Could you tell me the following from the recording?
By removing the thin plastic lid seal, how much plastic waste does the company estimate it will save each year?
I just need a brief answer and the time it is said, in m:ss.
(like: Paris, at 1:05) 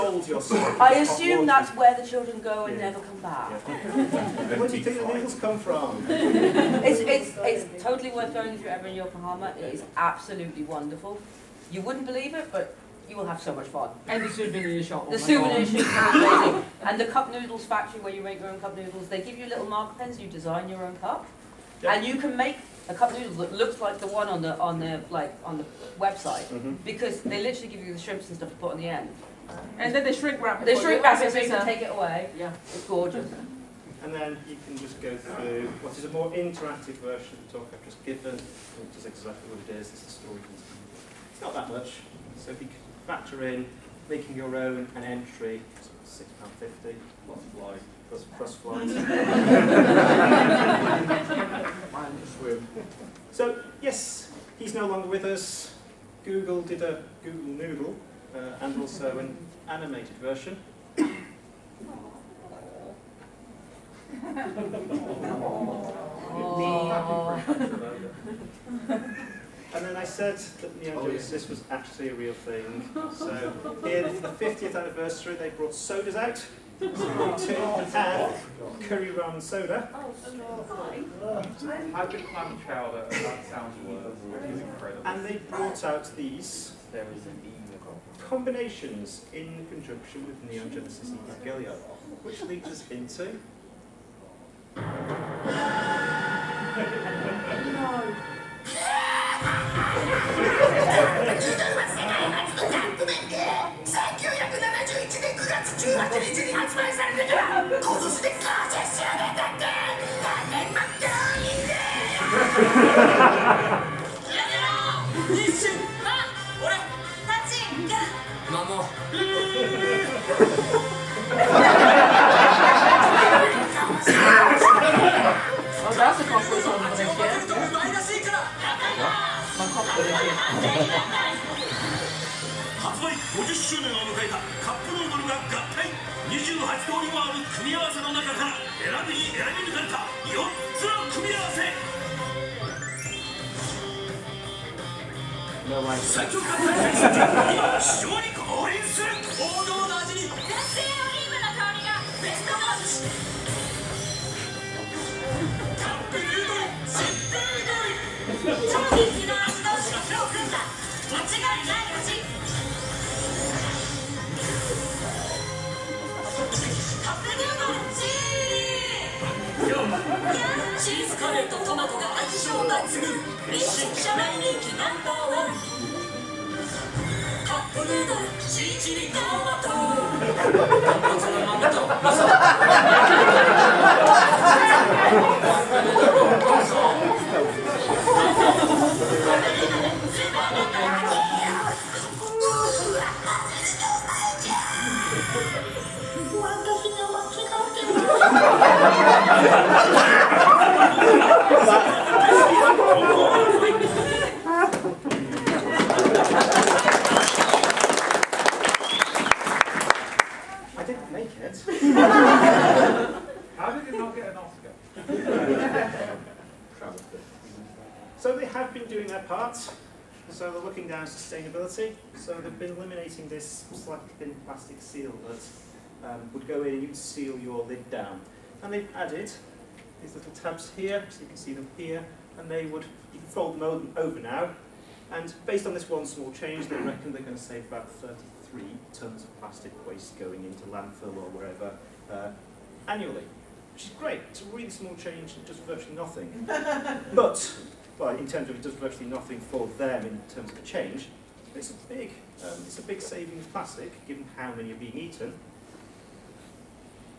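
33 tonnes, at 3:57.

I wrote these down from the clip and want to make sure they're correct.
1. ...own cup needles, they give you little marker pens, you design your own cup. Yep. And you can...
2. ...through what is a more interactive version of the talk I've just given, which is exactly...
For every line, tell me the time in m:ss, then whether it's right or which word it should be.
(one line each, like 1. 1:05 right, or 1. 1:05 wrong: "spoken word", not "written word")
1. 0:18 wrong: "noodles", not "needles"
2. 0:35 right.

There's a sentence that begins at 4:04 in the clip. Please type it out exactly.
It's a really small change, and does virtually nothing.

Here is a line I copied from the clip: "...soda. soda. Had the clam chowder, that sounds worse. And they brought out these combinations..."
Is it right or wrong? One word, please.
right.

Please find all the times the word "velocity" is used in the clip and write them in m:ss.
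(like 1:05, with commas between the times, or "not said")
not said.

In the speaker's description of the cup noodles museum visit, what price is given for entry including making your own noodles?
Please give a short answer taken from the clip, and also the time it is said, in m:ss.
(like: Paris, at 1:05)
£6.50, at 0:46.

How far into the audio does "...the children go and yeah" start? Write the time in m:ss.
0:02.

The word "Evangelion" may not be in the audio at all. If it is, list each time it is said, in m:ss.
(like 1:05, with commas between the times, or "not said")
1:31.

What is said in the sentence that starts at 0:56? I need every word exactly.
Google did a Google Noodle, uh, and also an animated version.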